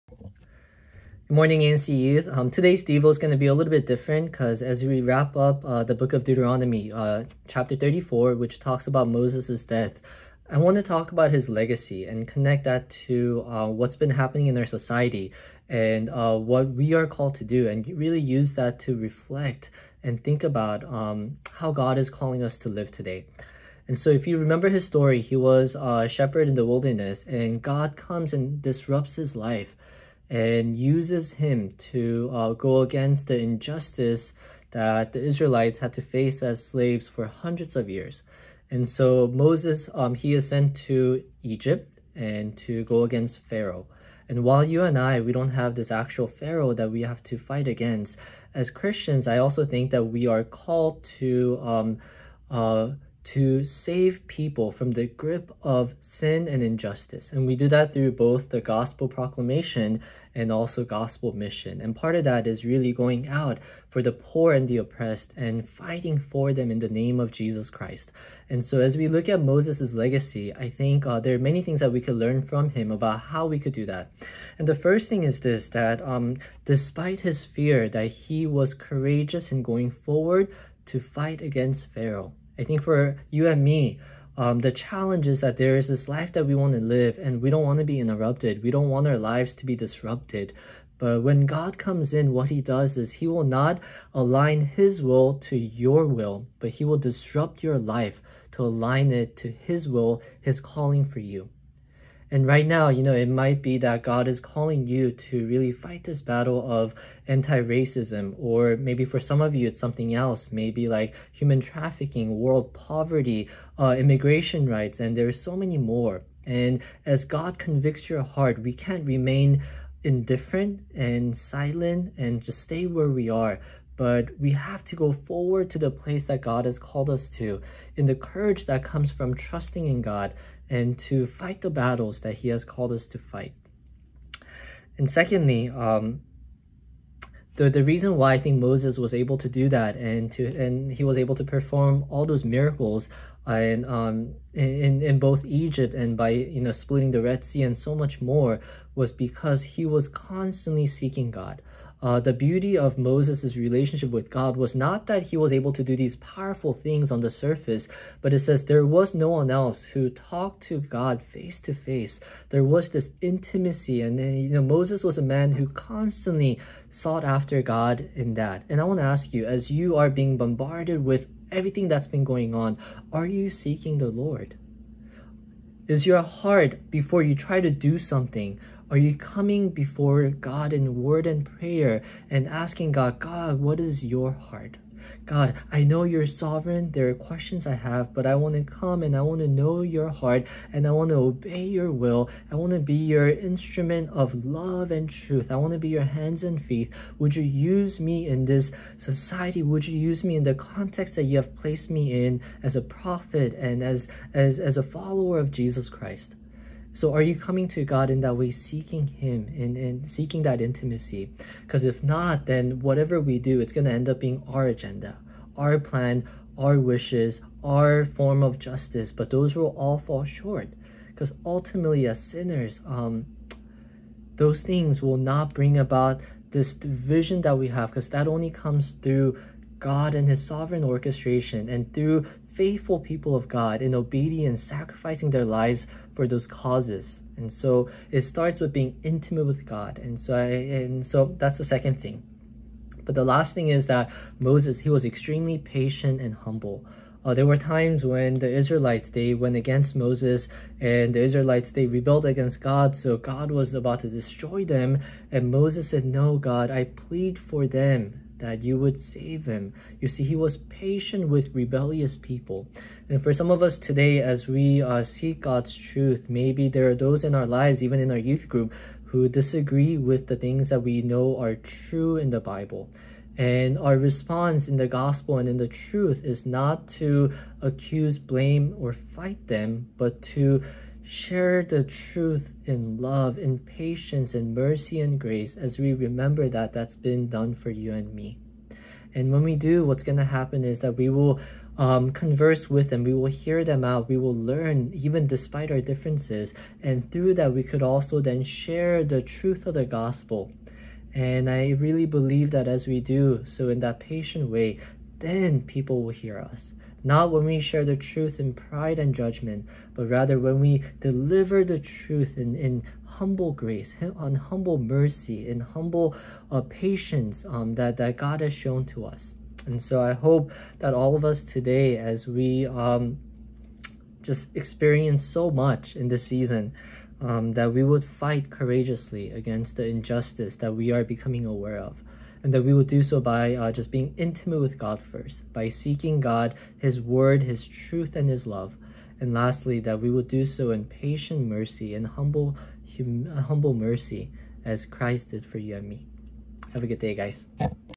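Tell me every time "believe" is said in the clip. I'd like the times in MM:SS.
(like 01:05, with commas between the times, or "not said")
05:02.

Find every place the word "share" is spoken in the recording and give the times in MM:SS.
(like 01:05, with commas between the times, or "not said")
04:41, 04:58, 05:07.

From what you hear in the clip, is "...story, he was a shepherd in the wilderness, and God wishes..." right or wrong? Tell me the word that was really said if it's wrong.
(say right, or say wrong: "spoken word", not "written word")
wrong: "comes", not "wishes".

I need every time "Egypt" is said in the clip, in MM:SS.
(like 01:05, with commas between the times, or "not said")
00:41, 02:25.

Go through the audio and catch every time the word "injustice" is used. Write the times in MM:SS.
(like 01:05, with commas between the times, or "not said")
00:33, 00:56, 05:29.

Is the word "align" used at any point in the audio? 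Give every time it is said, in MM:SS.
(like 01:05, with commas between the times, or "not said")
01:34, 01:38.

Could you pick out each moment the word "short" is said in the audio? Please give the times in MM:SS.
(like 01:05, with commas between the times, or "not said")
03:40.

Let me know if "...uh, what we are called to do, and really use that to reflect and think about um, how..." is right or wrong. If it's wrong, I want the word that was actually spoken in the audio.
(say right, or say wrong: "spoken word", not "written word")
right.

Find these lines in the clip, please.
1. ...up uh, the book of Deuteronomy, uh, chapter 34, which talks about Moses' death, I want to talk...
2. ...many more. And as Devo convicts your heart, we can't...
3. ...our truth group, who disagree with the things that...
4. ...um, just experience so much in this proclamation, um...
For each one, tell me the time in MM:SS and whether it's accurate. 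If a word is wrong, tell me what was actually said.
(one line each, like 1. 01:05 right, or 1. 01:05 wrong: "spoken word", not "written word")
1. 00:05 right
2. 01:55 wrong: "God", not "Devo"
3. 04:28 wrong: "youth", not "truth"
4. 05:22 wrong: "season", not "proclamation".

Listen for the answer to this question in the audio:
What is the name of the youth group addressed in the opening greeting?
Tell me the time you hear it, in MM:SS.
00:01.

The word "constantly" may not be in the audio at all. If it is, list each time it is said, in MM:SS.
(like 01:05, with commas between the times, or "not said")
02:30, 02:45.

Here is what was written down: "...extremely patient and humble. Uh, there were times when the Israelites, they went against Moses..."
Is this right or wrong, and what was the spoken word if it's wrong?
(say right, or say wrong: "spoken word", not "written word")
right.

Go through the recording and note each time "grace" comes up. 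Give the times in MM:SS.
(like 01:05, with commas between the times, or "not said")
04:45, 05:13.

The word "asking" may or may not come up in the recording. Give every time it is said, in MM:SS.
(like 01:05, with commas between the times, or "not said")
03:02.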